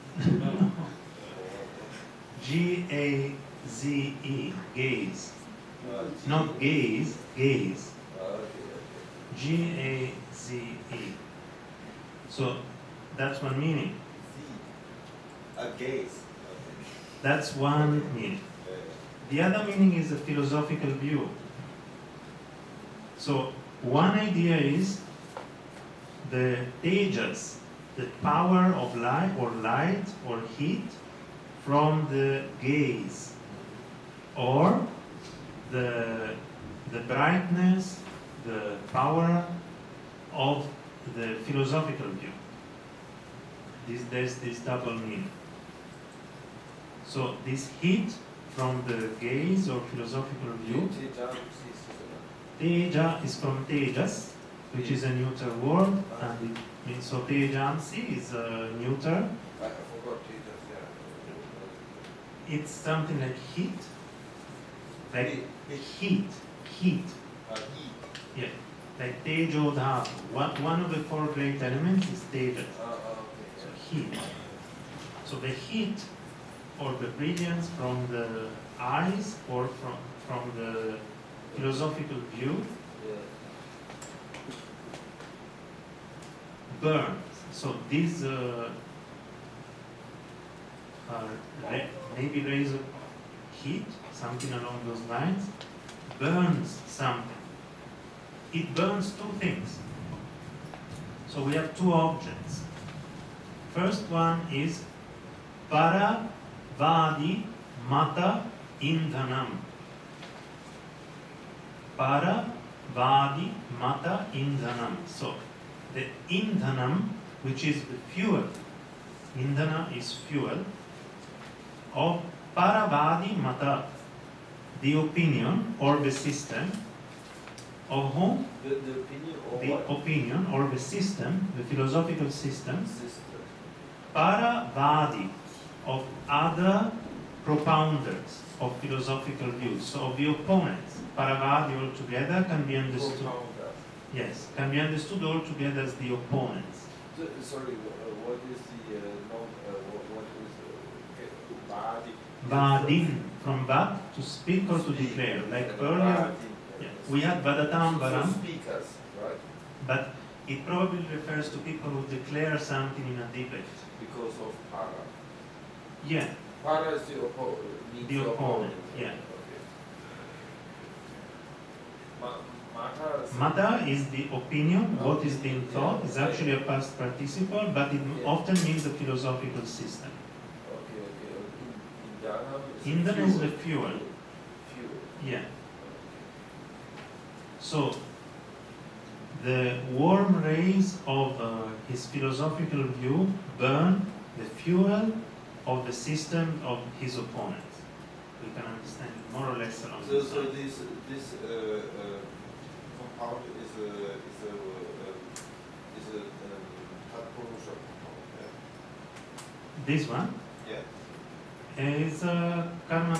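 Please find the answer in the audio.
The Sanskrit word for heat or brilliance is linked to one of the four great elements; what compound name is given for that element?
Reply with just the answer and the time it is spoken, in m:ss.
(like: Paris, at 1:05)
Tejo Dhatu, at 1:09.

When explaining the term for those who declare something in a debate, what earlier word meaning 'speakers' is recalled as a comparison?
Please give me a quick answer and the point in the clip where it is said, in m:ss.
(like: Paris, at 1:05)
Vadatambaram, at 2:37.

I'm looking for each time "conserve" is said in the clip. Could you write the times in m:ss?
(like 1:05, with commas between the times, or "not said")
not said.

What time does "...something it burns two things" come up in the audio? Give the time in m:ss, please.
1:36.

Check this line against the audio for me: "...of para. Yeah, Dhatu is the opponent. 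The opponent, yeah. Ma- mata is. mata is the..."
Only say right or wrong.
wrong.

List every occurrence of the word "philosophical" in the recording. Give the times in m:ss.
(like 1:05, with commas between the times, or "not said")
0:20, 0:41, 0:49, 1:21, 2:11, 2:18, 2:58, 3:12.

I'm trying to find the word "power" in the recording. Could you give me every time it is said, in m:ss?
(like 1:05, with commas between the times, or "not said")
0:28, 0:38.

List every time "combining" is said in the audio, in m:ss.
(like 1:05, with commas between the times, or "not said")
not said.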